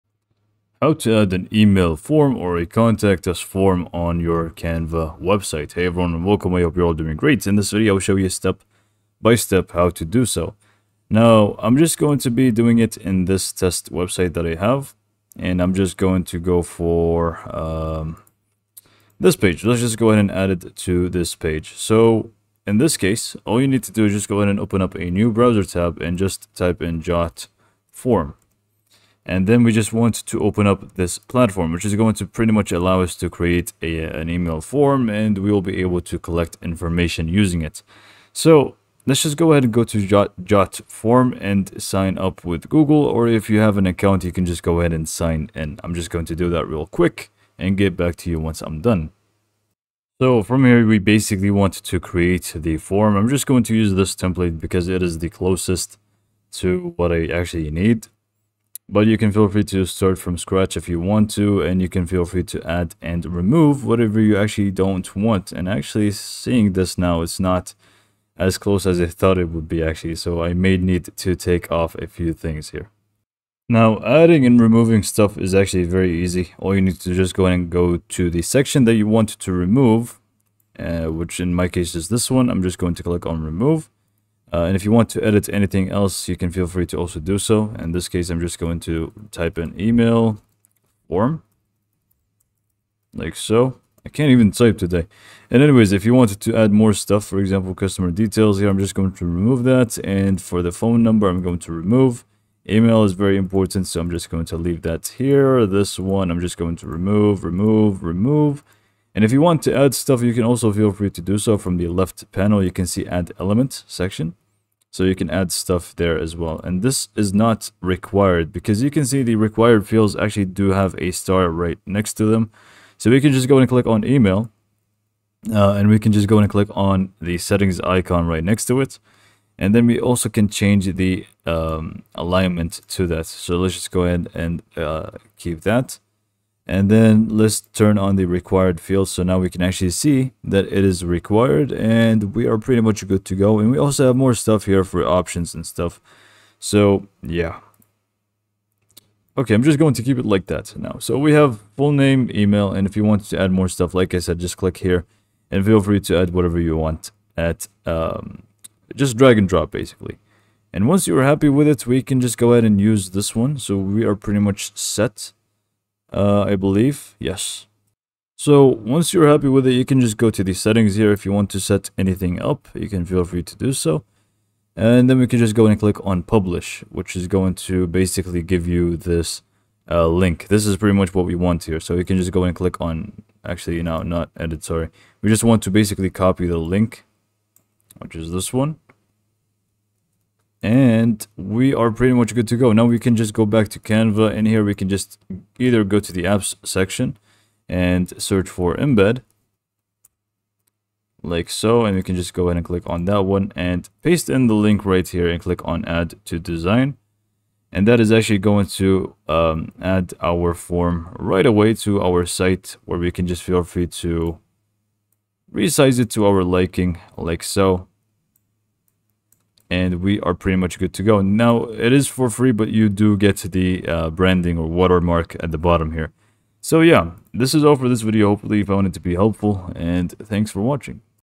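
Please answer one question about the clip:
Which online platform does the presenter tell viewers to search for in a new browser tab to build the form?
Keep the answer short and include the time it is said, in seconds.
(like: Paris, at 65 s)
Jotform, at 27 s.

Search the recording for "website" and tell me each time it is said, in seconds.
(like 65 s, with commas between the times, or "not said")
5 s, 13 s.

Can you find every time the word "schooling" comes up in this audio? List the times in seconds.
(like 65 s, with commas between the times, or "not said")
not said.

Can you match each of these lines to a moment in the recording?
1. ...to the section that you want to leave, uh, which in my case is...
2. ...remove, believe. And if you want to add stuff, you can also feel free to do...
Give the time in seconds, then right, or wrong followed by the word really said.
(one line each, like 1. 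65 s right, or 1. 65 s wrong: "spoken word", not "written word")
1. 78 s wrong: "remove", not "leave"
2. 107 s wrong: "remove", not "believe".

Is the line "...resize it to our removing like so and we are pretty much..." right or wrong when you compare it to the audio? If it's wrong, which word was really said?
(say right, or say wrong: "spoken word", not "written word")
wrong: "liking", not "removing".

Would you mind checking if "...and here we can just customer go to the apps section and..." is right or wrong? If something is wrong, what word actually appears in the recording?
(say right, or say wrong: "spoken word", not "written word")
wrong: "either", not "customer".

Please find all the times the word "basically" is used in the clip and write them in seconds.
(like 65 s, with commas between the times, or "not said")
50 s, 159 s, 177 s, 185 s.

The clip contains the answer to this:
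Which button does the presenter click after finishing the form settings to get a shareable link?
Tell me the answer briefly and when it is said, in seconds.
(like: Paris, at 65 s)
Publish, at 176 s.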